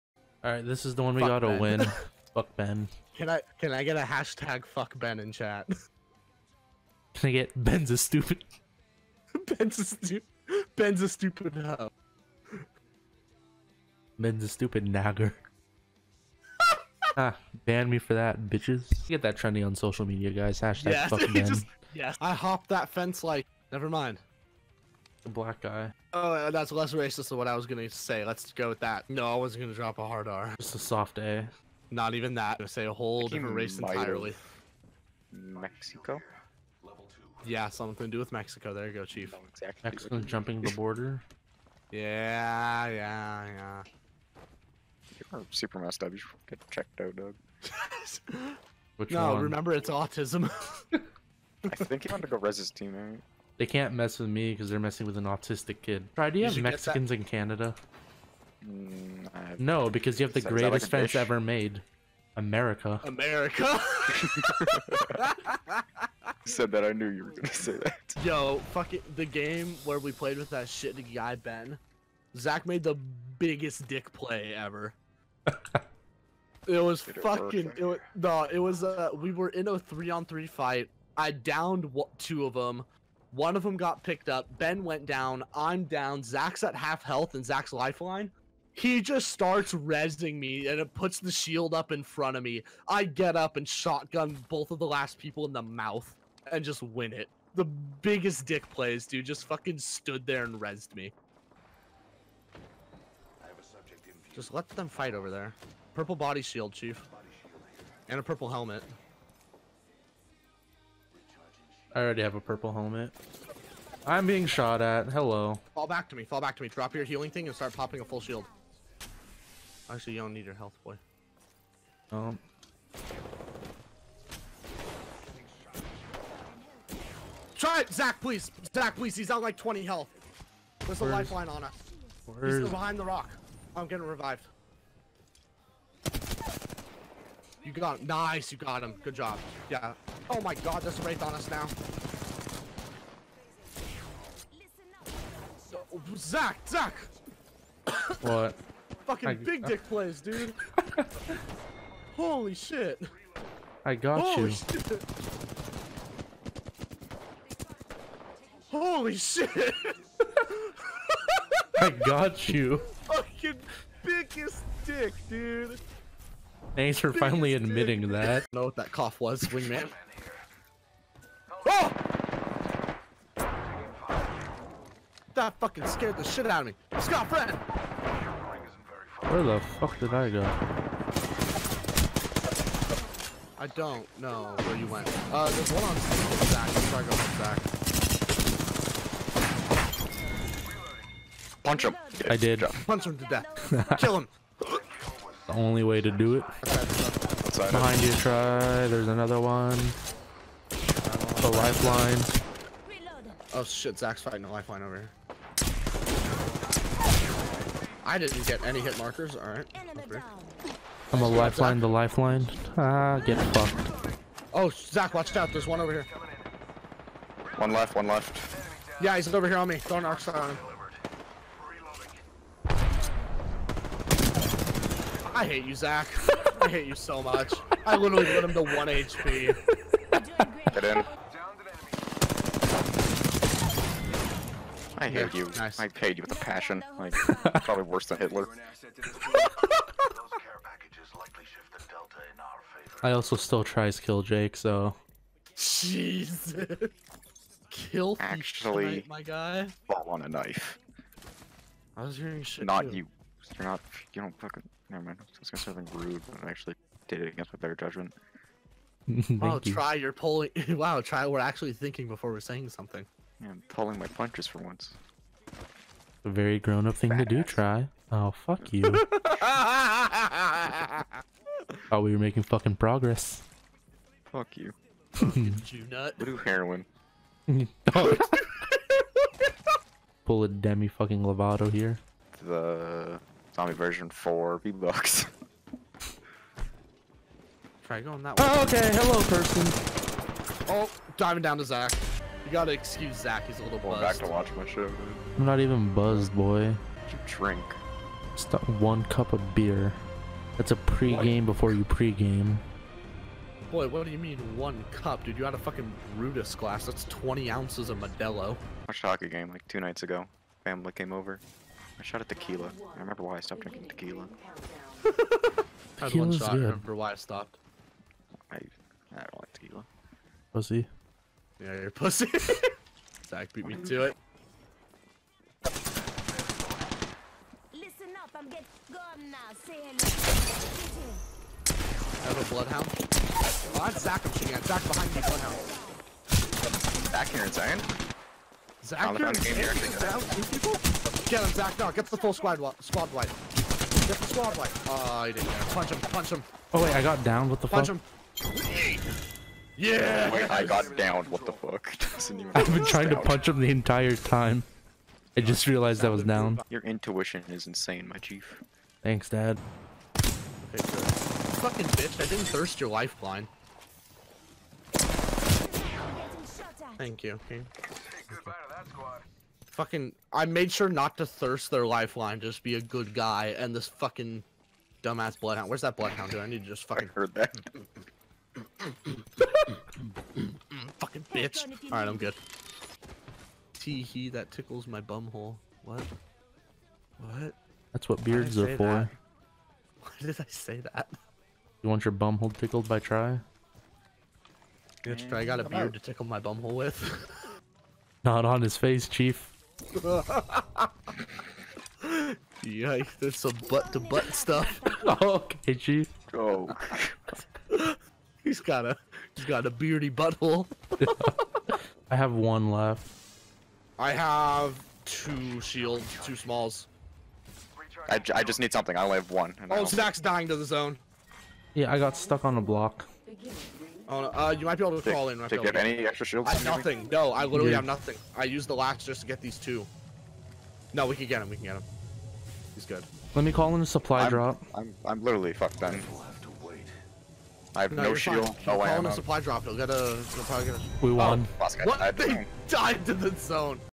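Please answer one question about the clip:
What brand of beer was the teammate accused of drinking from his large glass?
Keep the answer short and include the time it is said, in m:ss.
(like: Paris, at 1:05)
Modelo, at 5:07.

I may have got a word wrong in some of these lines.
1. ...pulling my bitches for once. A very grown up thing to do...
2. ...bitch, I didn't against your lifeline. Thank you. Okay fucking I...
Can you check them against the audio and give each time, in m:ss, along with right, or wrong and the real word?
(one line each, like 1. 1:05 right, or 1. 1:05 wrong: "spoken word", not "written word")
1. 4:23 wrong: "punches", not "bitches"
2. 6:01 wrong: "thirst", not "against".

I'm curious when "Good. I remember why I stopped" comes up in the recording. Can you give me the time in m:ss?
5:16.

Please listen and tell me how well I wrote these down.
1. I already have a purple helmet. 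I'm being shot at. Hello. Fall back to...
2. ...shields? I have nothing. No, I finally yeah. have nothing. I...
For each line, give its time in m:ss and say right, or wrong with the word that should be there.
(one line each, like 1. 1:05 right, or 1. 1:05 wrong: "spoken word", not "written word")
1. 1:51 right
2. 7:06 wrong: "literally", not "finally".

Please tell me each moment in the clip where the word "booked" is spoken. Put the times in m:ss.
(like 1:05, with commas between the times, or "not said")
not said.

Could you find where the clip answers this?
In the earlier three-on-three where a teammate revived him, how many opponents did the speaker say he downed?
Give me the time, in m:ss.
1:21.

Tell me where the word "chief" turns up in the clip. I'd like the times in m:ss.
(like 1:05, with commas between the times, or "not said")
0:39, 1:46, 5:58, 6:39, 6:45.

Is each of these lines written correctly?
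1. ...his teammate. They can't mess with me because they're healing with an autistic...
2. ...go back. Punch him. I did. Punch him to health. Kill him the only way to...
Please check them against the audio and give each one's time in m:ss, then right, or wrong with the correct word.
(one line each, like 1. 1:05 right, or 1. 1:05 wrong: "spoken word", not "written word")
1. 0:52 wrong: "messing", not "healing"
2. 3:07 wrong: "death", not "health".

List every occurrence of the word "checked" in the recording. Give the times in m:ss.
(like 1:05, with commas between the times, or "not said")
0:46.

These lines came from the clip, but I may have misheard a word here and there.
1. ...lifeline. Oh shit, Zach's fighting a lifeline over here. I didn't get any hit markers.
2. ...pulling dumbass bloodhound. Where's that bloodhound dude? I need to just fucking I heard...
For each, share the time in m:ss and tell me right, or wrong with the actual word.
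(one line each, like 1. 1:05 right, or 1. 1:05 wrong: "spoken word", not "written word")
1. 3:21 right
2. 6:13 wrong: "fucking", not "pulling".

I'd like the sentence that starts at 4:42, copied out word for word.
The zombie version four V bucks.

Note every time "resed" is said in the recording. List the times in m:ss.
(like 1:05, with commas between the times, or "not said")
1:40.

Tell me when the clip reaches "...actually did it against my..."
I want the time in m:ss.
4:16.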